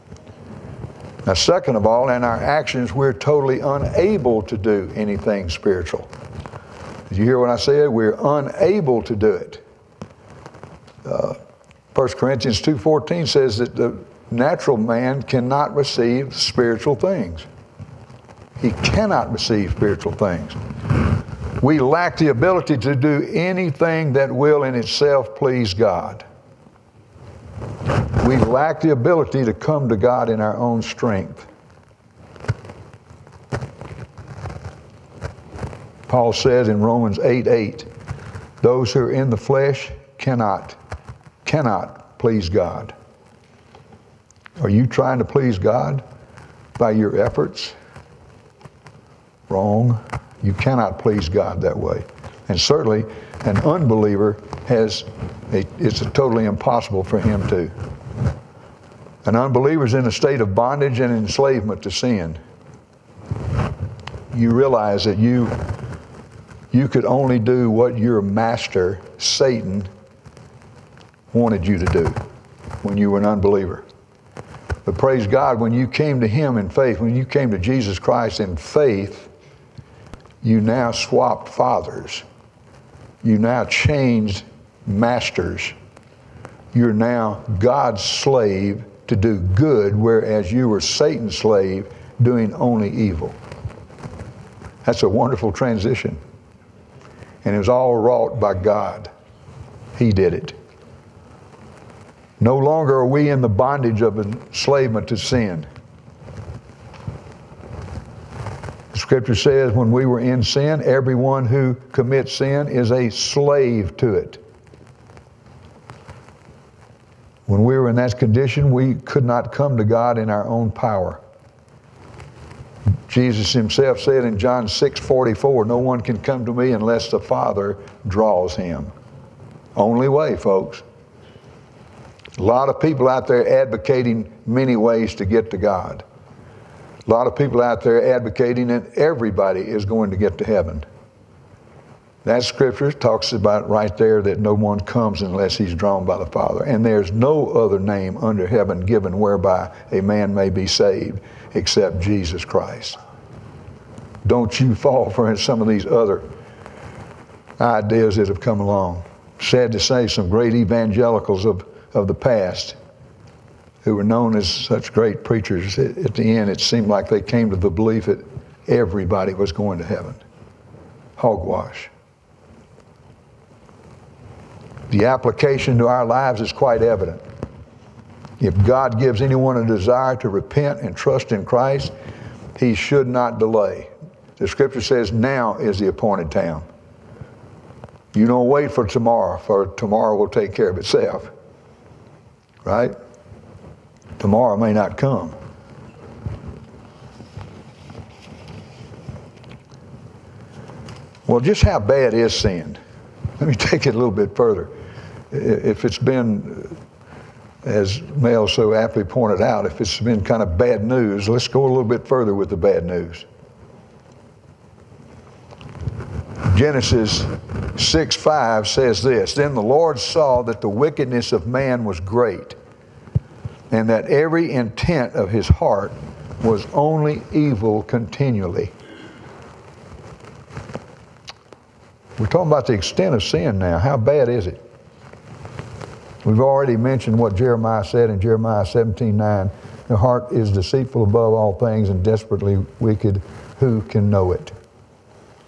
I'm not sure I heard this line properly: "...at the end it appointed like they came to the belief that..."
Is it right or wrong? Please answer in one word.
wrong.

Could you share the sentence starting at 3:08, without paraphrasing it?
You don't wait for tomorrow, for tomorrow will take care of itself right?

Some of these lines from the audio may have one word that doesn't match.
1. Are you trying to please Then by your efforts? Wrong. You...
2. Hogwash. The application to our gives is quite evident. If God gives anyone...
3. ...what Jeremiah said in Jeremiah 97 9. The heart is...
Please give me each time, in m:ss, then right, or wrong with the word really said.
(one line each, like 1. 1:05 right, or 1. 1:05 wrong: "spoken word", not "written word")
1. 0:44 wrong: "God", not "Then"
2. 2:51 wrong: "lives", not "gives"
3. 3:57 wrong: "17", not "97".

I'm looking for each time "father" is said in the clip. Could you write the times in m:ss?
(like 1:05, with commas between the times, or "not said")
1:21, 2:07, 2:26.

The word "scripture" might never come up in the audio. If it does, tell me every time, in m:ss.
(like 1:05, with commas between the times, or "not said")
1:48, 2:22, 3:04.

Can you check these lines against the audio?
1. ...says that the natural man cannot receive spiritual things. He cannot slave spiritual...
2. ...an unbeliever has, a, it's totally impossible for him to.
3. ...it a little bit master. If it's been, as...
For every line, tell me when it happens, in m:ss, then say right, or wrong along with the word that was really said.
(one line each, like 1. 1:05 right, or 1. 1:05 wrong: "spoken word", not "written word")
1. 0:13 wrong: "receive", not "slave"
2. 0:53 right
3. 3:23 wrong: "further", not "master".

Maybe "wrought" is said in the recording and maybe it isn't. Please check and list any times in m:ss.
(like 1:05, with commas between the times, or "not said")
1:37.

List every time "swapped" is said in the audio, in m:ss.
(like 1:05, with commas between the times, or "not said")
1:20.